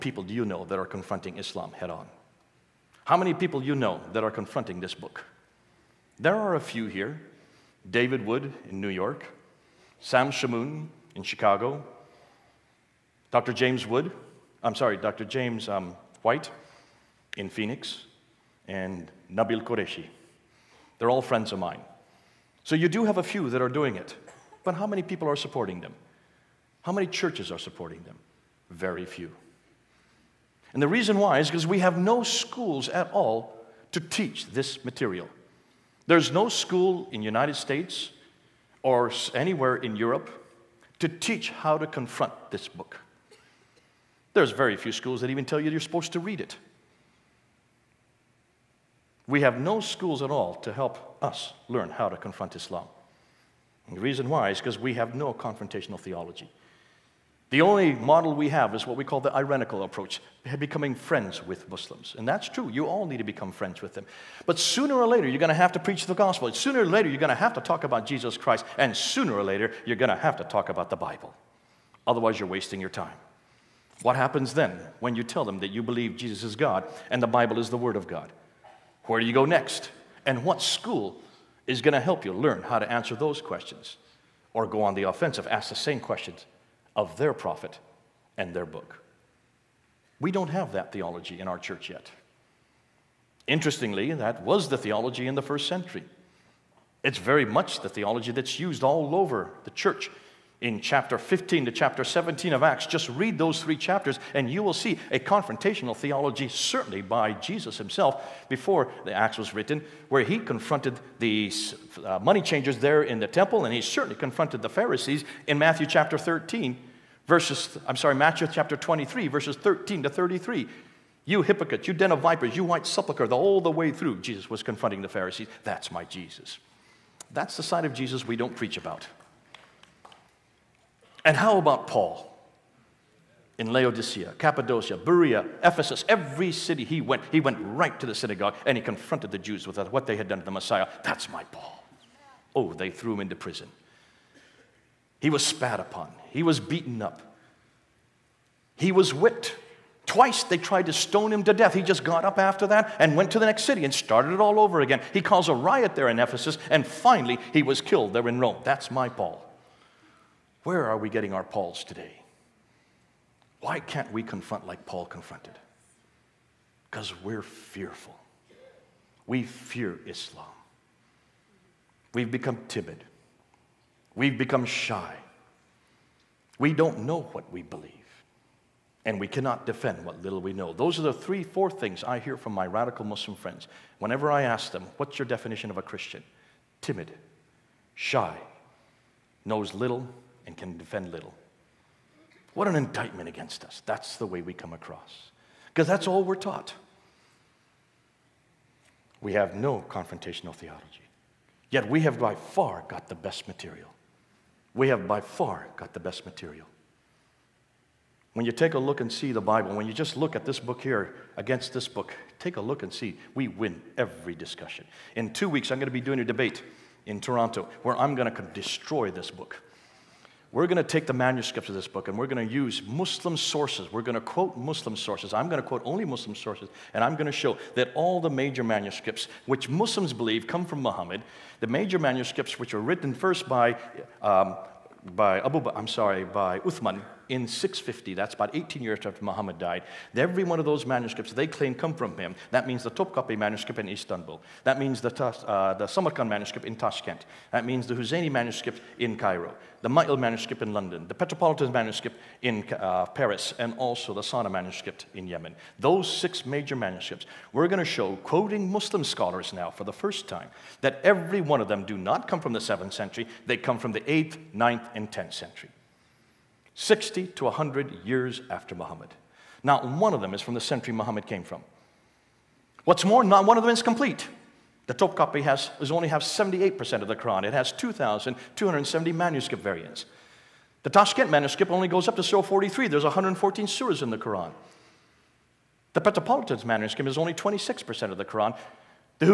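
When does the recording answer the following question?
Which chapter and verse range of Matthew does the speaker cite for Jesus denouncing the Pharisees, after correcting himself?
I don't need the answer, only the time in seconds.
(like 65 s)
118 s.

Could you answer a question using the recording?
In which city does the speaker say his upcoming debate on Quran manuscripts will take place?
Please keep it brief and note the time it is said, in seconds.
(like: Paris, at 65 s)
Toronto, at 217 s.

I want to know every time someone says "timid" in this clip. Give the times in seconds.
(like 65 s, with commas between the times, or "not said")
172 s, 186 s.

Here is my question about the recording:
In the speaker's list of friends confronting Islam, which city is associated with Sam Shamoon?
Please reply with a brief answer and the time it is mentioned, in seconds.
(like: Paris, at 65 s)
Chicago, at 11 s.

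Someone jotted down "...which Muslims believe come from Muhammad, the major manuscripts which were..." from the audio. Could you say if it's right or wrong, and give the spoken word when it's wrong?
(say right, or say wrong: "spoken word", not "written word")
right.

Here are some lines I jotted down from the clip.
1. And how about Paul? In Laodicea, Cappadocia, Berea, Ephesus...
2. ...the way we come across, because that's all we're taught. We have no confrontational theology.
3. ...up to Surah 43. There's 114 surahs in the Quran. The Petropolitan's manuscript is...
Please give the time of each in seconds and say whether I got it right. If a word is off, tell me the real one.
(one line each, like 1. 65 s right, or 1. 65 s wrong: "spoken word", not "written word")
1. 131 s right
2. 194 s right
3. 282 s right.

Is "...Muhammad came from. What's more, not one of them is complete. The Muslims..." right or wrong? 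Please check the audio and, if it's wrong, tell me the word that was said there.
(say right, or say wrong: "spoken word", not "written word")
wrong: "Topkapi", not "Muslims".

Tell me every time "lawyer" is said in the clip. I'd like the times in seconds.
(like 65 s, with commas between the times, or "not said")
not said.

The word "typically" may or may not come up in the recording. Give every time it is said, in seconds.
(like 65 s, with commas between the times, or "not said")
not said.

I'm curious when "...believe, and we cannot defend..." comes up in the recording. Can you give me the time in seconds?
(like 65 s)
177 s.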